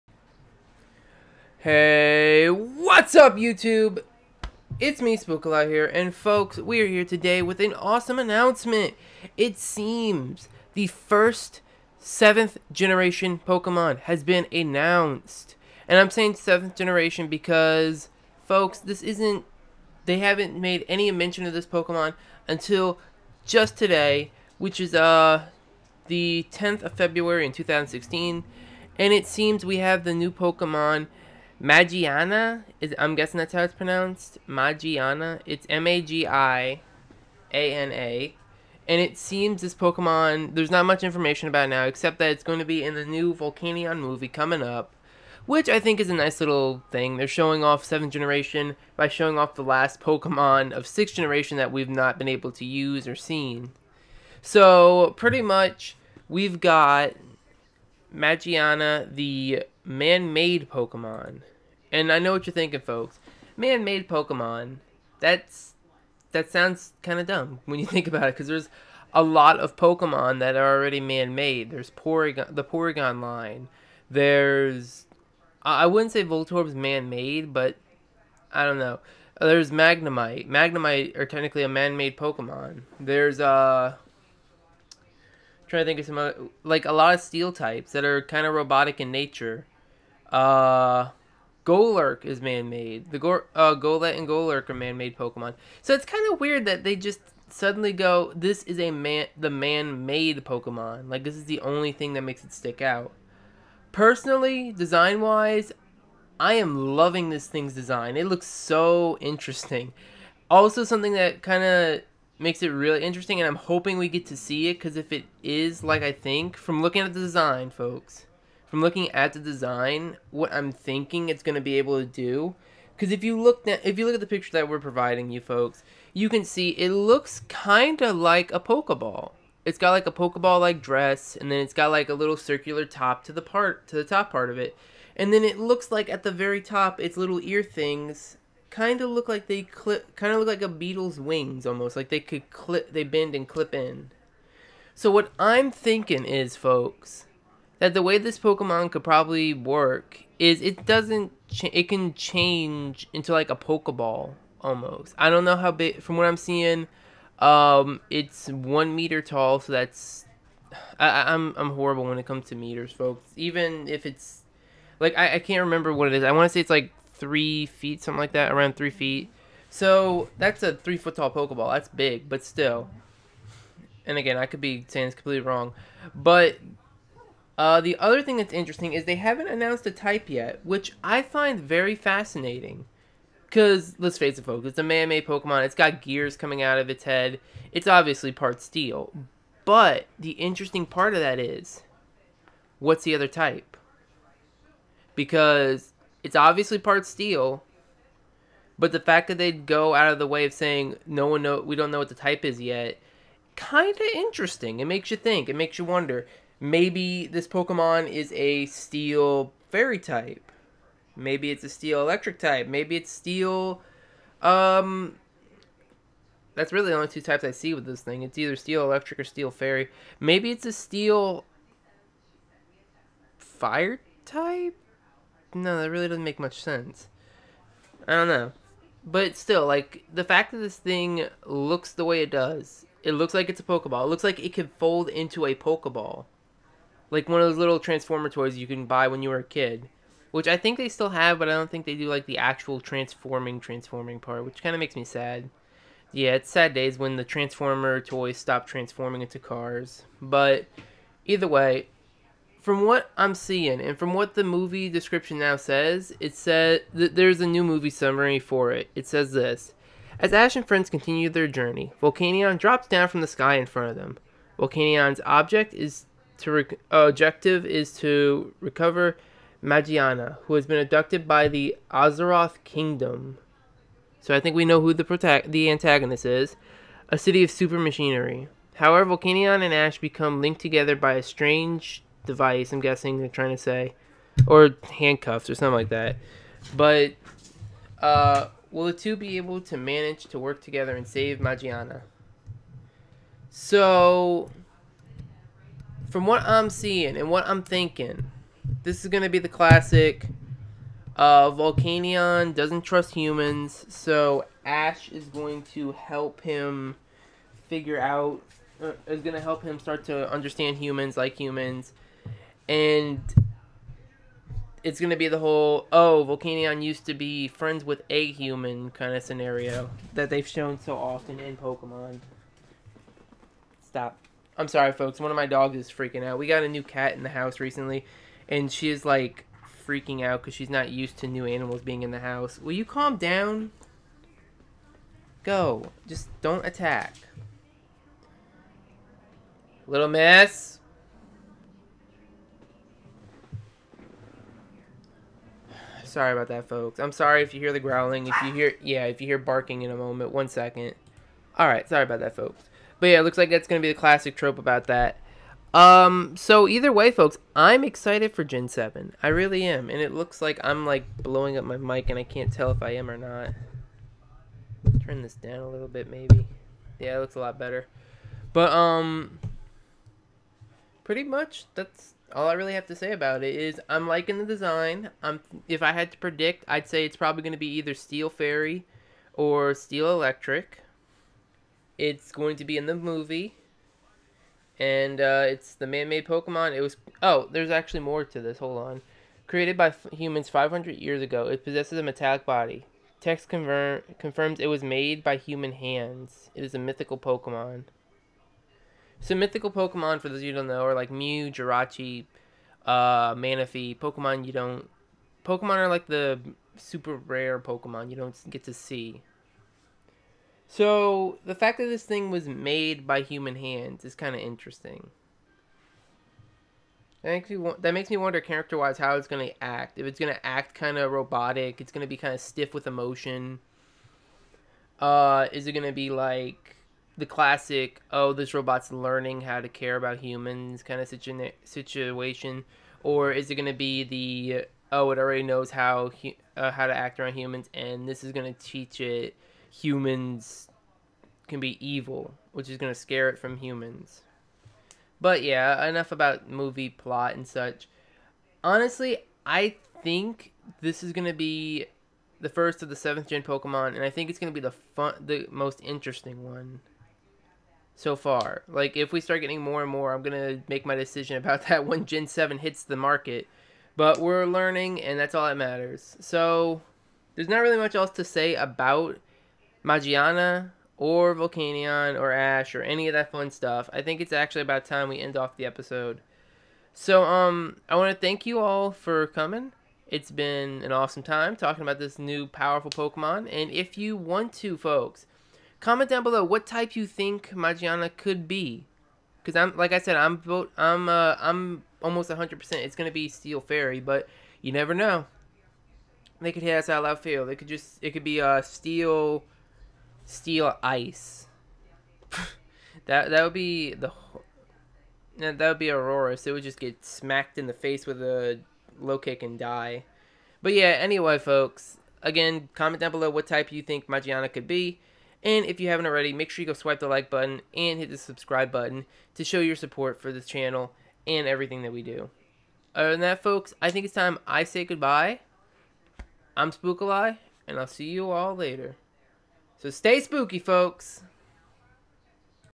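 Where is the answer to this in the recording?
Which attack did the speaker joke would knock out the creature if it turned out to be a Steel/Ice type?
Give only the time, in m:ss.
8:28.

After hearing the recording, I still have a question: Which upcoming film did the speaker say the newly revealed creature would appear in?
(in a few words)
Volcanion movie.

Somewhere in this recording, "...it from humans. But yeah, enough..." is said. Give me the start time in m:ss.
7:23.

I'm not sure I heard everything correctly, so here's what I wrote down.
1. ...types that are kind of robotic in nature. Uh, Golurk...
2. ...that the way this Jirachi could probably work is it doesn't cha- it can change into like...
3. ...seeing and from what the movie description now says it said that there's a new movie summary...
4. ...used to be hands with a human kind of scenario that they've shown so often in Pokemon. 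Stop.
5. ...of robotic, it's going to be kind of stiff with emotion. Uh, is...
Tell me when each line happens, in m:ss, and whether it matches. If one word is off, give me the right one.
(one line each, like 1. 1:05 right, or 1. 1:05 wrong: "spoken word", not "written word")
1. 1:27 right
2. 2:27 wrong: "Pokemon", not "Jirachi"
3. 4:13 right
4. 5:16 wrong: "friends", not "hands"
5. 7:00 right.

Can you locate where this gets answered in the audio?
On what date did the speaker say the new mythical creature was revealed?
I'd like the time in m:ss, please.
0:26.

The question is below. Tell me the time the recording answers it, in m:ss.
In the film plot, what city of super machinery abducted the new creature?
4:31.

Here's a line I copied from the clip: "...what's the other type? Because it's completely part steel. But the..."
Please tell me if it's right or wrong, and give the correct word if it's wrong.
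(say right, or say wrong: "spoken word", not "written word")
wrong: "obviously", not "completely".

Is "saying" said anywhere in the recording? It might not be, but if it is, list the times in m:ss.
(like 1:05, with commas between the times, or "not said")
0:16, 2:54, 3:20.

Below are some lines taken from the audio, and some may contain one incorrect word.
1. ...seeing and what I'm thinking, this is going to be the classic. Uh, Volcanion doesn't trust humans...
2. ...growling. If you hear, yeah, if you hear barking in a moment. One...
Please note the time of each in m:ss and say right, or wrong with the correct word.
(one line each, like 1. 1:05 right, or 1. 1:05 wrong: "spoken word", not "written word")
1. 4:56 right
2. 5:47 right.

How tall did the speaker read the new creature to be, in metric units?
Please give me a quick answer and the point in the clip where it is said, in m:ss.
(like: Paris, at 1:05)
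1 meter, at 2:38.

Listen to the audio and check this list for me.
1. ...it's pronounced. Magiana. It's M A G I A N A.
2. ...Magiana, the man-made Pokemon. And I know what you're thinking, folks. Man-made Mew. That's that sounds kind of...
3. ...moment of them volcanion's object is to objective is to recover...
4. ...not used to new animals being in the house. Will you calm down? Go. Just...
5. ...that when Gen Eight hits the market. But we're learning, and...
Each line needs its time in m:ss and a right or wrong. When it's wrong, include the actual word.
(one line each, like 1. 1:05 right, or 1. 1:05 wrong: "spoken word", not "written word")
1. 0:33 right
2. 0:58 wrong: "Pokemon", not "Mew"
3. 4:23 wrong: "front", not "moment"
4. 5:30 right
5. 7:41 wrong: "Seven", not "Eight".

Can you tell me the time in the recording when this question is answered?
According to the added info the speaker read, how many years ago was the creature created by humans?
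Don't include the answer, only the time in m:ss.
6:30.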